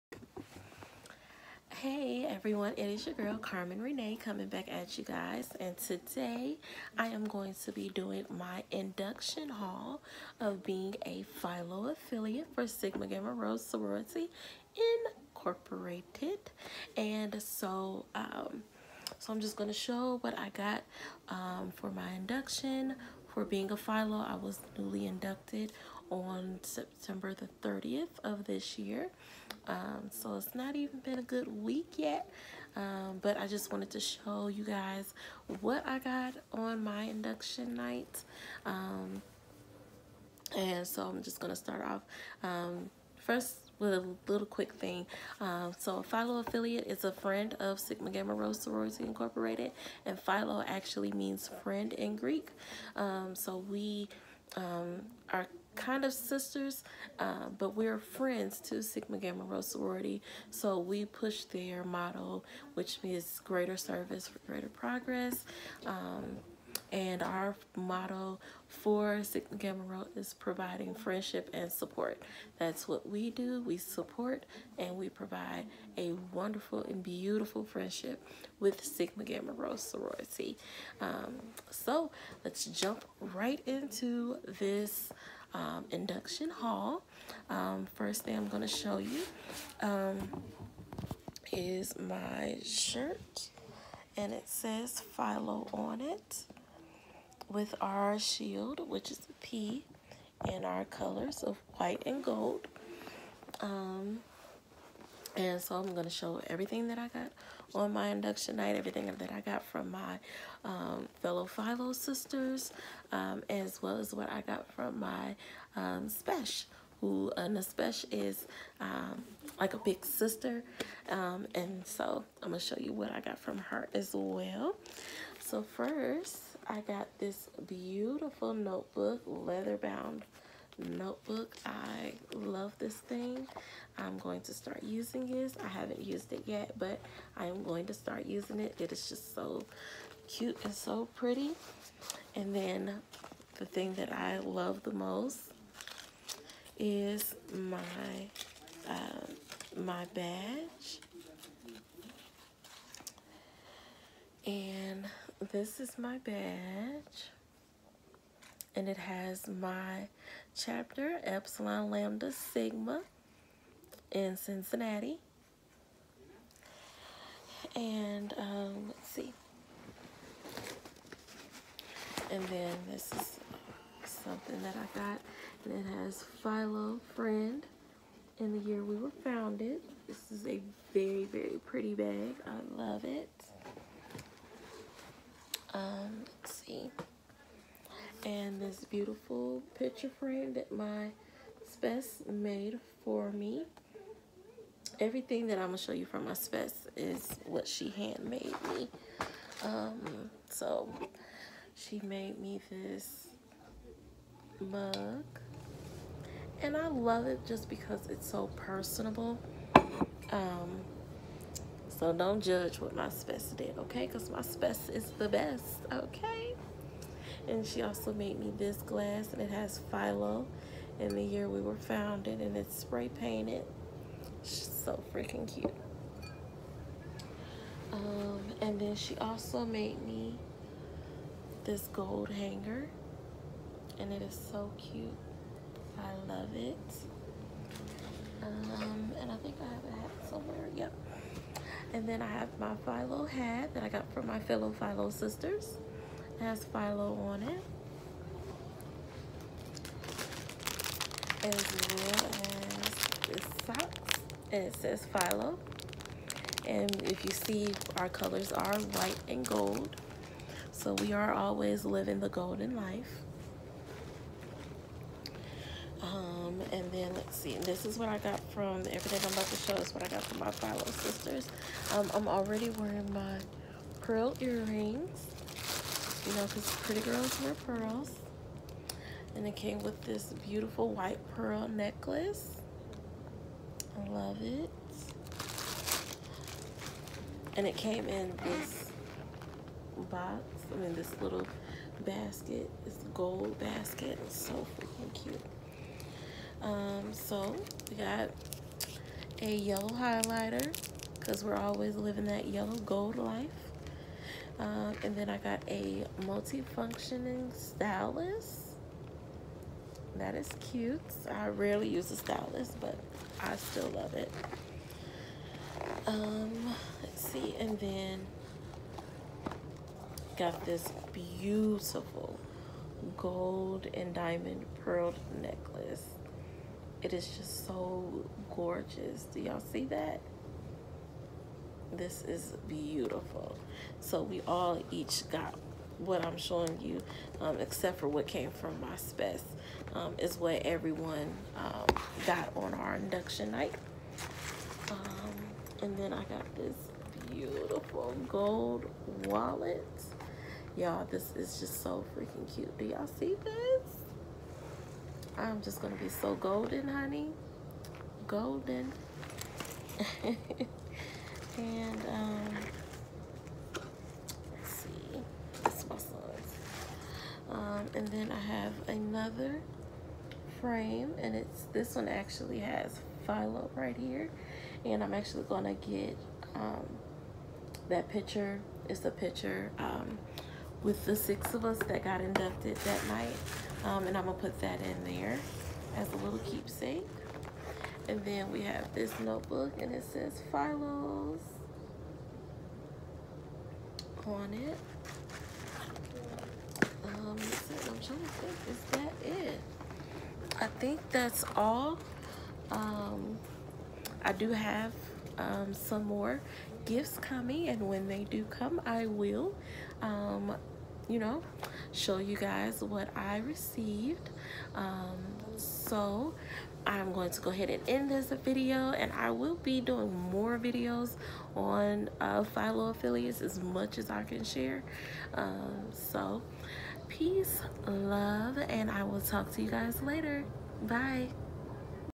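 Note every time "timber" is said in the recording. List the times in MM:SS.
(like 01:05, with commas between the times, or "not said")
not said.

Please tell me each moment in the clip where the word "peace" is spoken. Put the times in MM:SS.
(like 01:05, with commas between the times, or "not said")
07:07.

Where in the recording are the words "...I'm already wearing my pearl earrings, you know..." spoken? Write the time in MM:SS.
04:32.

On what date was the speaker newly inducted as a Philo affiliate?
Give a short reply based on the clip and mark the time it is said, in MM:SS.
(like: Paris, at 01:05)
September 30, at 00:26.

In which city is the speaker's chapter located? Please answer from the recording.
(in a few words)
Cincinnati.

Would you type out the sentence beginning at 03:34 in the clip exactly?
Because my spes is the best, okay?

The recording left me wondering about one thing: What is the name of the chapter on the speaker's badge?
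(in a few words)
Epsilon Lambda Sigma.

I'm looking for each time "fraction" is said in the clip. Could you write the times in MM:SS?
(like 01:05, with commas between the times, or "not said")
not said.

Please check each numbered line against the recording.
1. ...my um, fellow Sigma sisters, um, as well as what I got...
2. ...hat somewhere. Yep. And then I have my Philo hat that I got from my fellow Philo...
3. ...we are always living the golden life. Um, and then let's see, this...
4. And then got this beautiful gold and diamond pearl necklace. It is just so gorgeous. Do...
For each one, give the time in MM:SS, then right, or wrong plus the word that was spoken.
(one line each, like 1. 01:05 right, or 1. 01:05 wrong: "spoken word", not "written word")
1. 01:49 wrong: "Philo", not "Sigma"
2. 04:00 right
3. 04:20 right
4. 05:17 right.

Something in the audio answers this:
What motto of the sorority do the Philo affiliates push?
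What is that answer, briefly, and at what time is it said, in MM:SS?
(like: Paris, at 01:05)
Greater service for greater progress, at 01:03.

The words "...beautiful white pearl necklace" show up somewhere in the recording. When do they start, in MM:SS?
04:40.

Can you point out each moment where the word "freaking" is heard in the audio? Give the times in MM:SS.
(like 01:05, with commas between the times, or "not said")
03:45, 04:54, 05:52.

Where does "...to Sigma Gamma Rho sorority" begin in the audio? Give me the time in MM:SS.
00:58.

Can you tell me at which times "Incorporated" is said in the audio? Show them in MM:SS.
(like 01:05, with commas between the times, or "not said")
00:15, 00:49.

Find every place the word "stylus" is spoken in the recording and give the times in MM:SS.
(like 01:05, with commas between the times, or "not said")
05:07, 05:12.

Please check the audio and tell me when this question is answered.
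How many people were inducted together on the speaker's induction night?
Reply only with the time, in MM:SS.
06:21.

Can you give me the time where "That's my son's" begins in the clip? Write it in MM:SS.
06:05.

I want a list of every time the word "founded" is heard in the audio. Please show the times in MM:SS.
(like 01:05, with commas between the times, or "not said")
02:59, 03:41.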